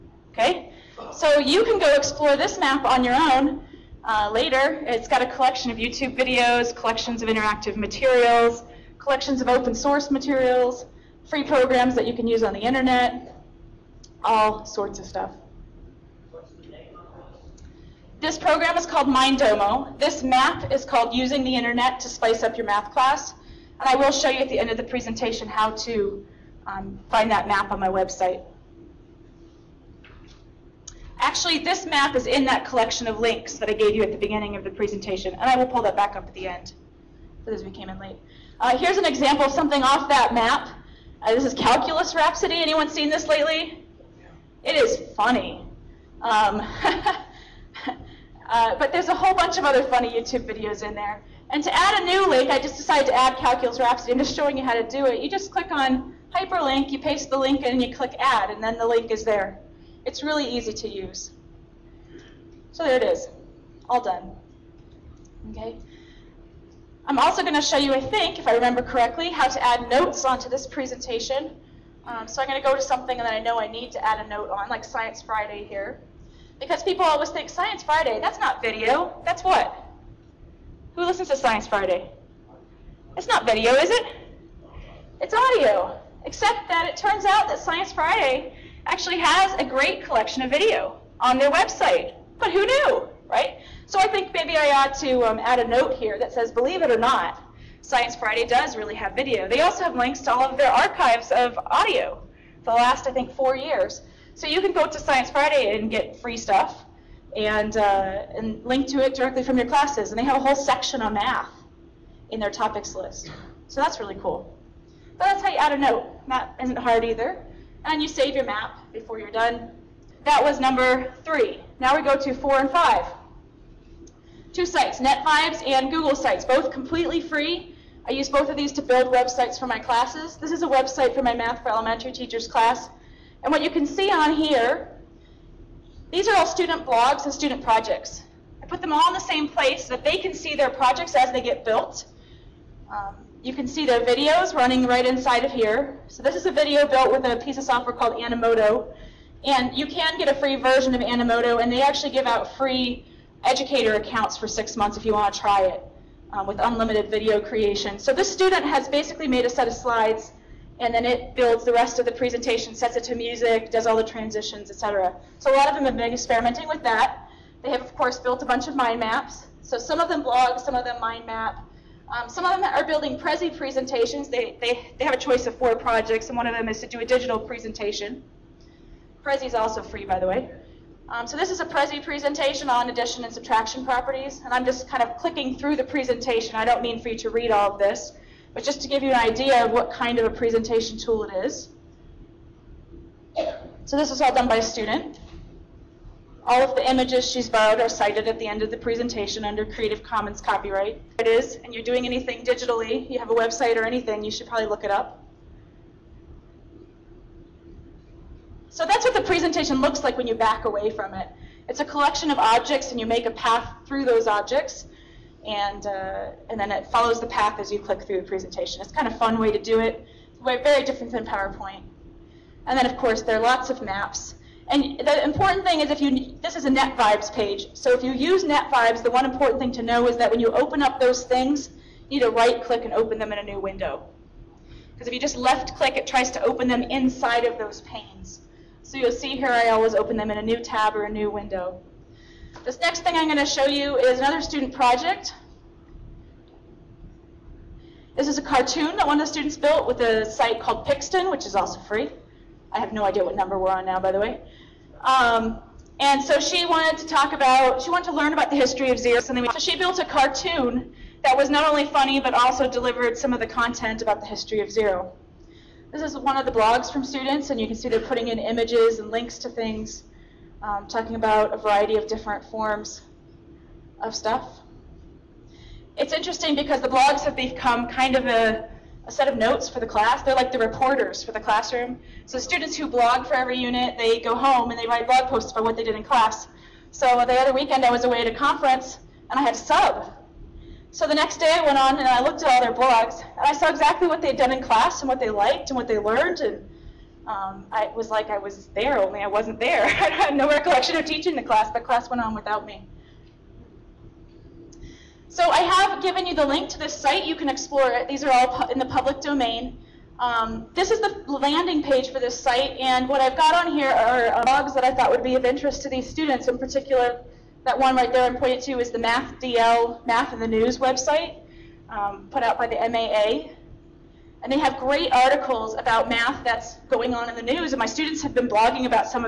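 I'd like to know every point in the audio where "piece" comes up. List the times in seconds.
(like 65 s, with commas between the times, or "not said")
147 s.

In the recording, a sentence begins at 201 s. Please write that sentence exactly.
If it is, and you're doing anything digitally, you have a website or anything, you should probably look it up.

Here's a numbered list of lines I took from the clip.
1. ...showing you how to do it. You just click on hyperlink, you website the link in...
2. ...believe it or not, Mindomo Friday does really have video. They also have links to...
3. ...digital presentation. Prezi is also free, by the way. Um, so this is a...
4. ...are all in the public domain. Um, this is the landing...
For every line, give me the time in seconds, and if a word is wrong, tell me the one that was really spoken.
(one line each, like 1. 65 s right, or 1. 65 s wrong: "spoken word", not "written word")
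1. 54 s wrong: "paste", not "website"
2. 96 s wrong: "Science", not "Mindomo"
3. 177 s right
4. 308 s right.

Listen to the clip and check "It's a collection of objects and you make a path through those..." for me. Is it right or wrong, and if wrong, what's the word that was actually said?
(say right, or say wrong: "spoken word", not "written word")
right.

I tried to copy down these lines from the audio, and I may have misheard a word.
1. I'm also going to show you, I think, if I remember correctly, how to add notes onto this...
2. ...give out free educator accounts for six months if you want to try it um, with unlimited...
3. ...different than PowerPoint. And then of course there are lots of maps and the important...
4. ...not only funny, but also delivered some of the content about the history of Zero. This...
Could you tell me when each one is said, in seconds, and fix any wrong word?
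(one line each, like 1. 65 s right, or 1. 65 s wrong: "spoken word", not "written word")
1. 67 s right
2. 152 s right
3. 220 s right
4. 261 s right.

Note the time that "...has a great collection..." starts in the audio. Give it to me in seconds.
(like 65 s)
89 s.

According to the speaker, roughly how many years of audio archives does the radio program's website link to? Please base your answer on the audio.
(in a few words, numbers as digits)
4.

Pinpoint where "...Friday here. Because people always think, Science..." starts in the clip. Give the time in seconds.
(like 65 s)
75 s.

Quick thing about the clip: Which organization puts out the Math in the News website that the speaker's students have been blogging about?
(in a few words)
MAA.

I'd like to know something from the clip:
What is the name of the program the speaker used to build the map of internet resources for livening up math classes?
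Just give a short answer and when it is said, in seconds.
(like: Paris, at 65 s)
Mindomo, at 19 s.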